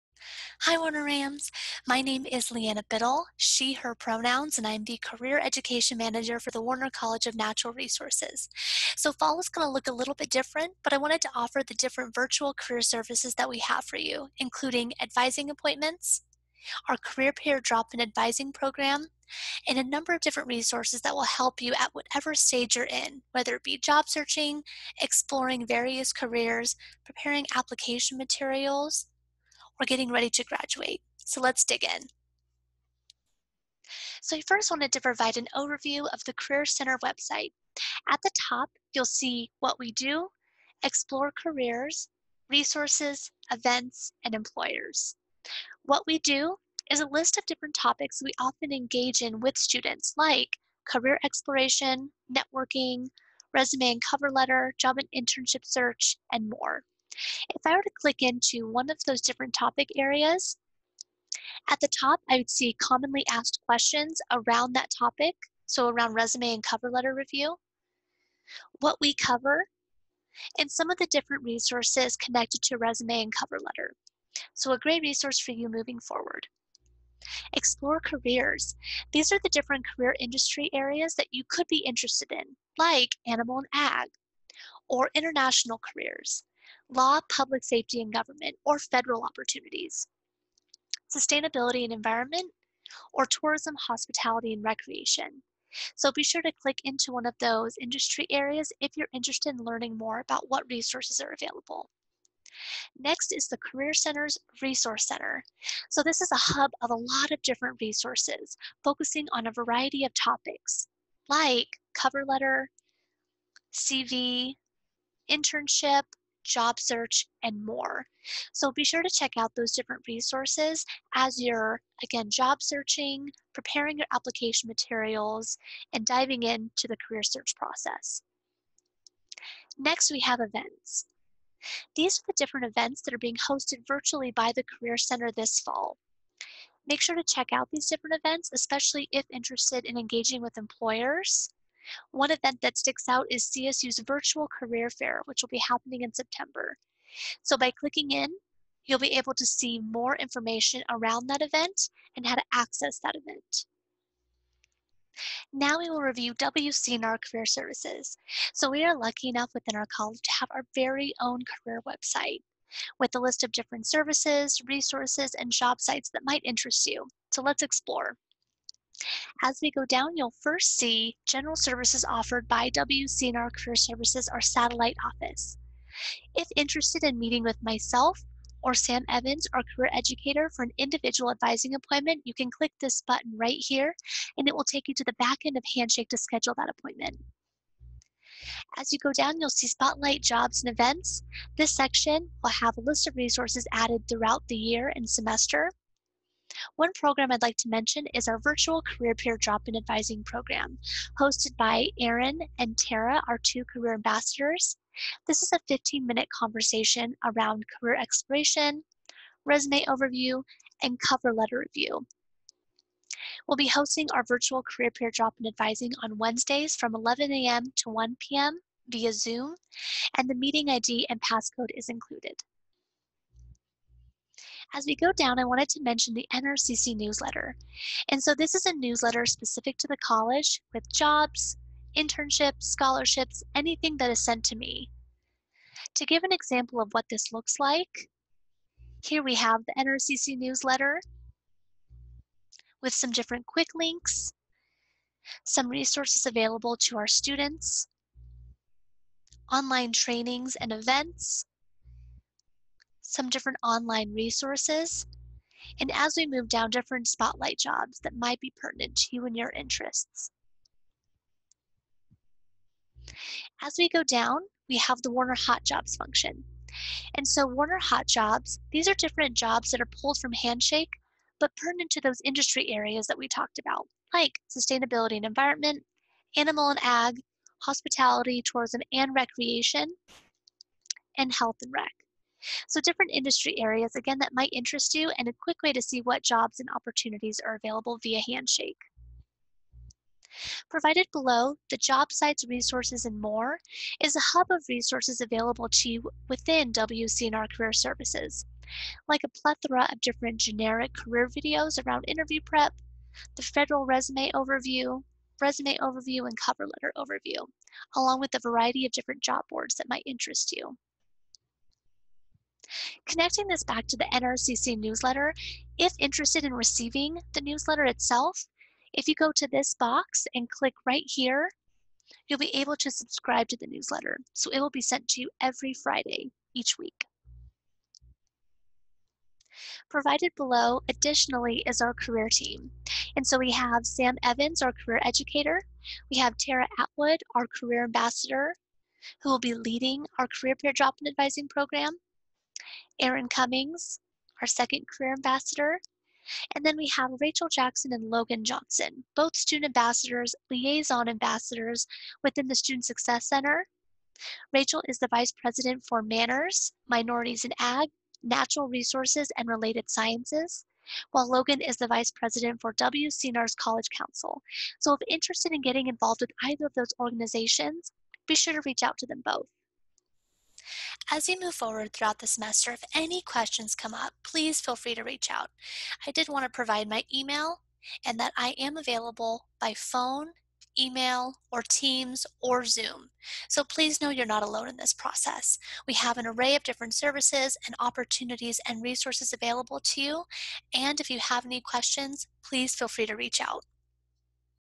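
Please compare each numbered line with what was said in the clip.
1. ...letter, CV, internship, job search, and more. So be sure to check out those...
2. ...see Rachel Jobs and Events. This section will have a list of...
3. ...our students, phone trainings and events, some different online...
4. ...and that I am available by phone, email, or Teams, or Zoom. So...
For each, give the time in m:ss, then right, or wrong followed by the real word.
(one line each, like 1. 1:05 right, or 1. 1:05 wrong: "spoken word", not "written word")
1. 1:52 right
2. 3:09 wrong: "Spotlight", not "Rachel"
3. 4:06 wrong: "online", not "phone"
4. 6:18 right.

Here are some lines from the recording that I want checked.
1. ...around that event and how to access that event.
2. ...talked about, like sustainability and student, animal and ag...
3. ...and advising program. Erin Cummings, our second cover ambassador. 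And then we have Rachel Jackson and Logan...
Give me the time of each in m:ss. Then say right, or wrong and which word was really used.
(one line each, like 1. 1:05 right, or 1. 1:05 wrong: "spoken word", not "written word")
1. 2:30 right
2. 4:33 wrong: "environment", not "student"
3. 5:41 wrong: "career", not "cover".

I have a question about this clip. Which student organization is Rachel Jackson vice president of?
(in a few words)
MANRRS.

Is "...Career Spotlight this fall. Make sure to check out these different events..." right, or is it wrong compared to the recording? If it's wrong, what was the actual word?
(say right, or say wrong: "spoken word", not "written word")
wrong: "Center", not "Spotlight".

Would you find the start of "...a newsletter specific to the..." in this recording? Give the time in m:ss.
3:48.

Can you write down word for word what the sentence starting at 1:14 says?
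So a great resource for you moving forward.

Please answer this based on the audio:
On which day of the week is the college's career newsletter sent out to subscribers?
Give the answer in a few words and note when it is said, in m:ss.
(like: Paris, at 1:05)
Friday, at 5:25.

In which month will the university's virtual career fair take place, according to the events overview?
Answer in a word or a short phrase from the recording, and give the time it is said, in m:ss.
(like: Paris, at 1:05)
September, at 2:26.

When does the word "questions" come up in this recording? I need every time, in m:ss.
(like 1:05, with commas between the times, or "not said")
1:03, 6:13, 6:31.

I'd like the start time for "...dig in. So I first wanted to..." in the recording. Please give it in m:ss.
0:31.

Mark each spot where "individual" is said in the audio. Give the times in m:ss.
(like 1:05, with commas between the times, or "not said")
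3:00.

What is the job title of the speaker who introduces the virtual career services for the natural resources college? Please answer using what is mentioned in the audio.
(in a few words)
Career Education Manager.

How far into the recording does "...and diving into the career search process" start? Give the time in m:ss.
2:05.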